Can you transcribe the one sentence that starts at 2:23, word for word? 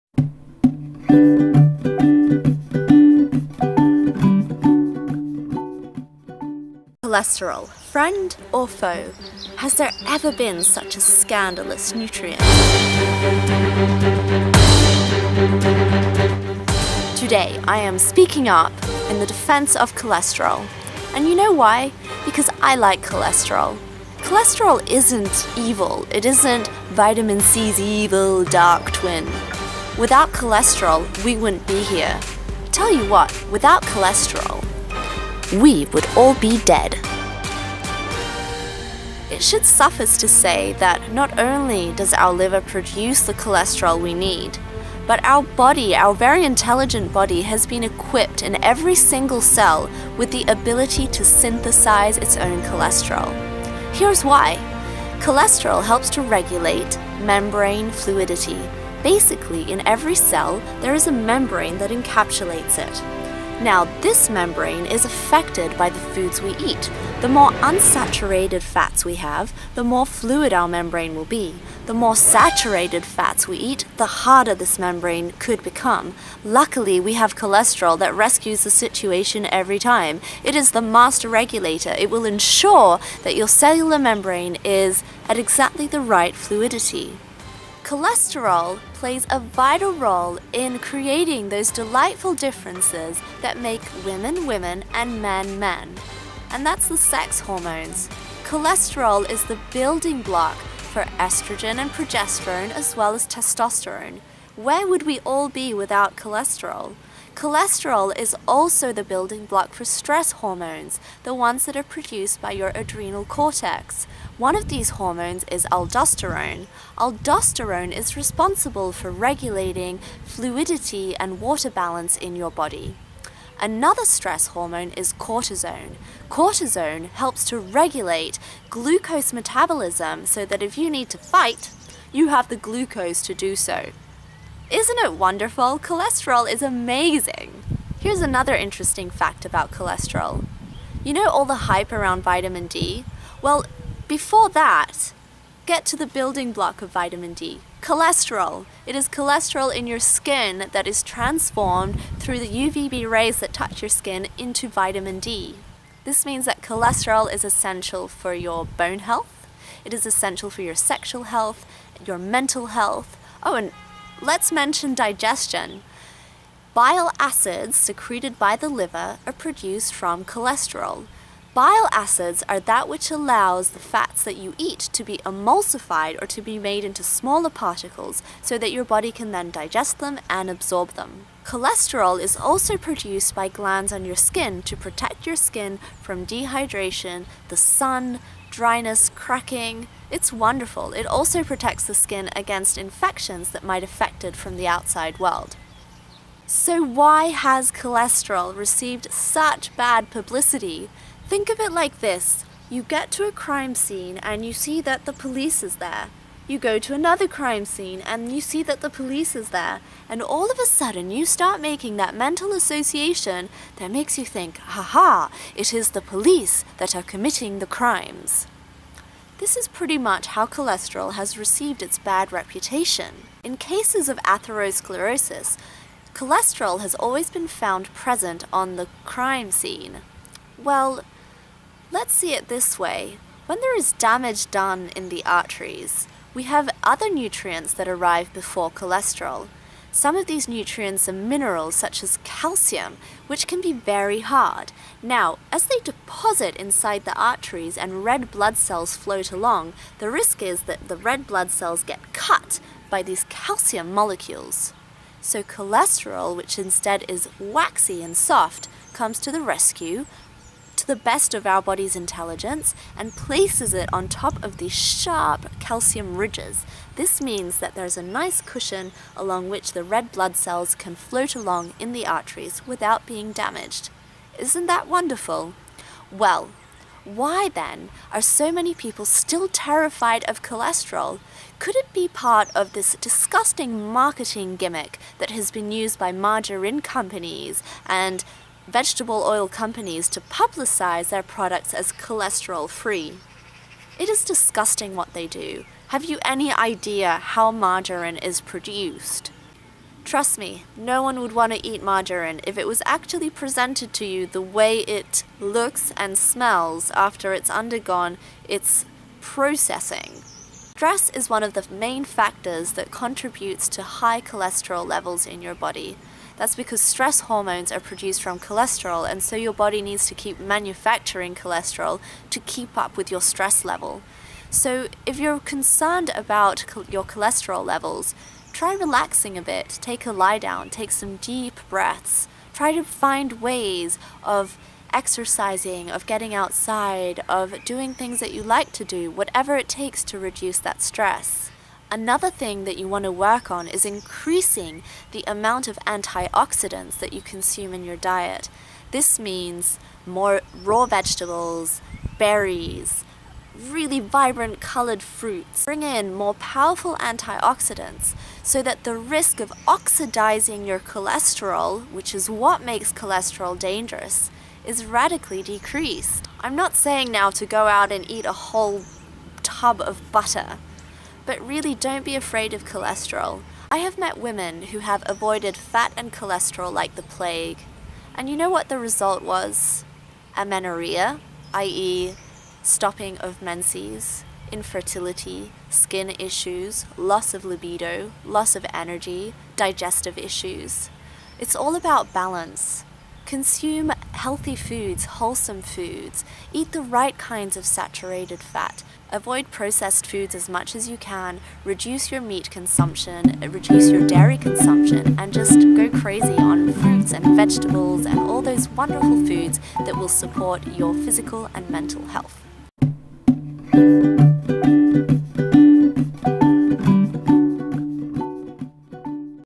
Well, before that, get to the building block of vitamin D.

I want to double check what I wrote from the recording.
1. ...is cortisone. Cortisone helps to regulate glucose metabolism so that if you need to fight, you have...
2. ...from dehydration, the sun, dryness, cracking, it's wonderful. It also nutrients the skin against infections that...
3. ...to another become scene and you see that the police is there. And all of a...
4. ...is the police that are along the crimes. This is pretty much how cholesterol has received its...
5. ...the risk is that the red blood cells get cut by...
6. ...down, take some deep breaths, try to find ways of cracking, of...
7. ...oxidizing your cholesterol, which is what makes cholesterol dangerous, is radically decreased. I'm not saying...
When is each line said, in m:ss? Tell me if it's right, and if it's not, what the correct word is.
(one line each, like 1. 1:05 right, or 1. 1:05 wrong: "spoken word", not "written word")
1. 2:04 right
2. 3:05 wrong: "protects", not "nutrients"
3. 3:26 wrong: "crime", not "become"
4. 3:35 wrong: "committing", not "along"
5. 4:09 right
6. 5:30 wrong: "exercising", not "cracking"
7. 5:59 right.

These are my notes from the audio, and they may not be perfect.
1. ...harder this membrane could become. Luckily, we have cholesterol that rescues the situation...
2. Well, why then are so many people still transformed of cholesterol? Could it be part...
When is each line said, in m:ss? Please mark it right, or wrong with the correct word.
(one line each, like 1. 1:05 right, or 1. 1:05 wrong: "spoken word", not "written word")
1. 1:14 right
2. 4:36 wrong: "terrified", not "transformed".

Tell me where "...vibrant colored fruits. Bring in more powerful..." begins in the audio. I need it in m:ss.
5:53.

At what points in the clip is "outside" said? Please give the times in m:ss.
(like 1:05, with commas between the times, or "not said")
3:14, 5:36.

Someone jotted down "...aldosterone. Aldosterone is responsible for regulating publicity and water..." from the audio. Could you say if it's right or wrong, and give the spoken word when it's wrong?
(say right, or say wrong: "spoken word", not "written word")
wrong: "fluidity", not "publicity".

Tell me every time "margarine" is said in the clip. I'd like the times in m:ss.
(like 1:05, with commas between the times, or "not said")
4:46, 4:57, 5:01.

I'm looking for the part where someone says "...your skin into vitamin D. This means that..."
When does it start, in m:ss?
2:33.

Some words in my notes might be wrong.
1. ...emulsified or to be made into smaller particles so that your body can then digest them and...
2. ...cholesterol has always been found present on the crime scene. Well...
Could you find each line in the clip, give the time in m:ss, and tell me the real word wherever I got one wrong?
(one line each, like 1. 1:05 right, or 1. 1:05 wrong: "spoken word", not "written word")
1. 2:55 right
2. 3:46 right.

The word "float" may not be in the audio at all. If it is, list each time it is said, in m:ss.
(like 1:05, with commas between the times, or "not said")
4:08, 4:30.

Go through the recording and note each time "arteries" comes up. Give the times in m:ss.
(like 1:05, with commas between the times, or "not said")
3:55, 4:07, 4:32.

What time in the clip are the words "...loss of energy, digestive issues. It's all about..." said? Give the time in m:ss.
6:28.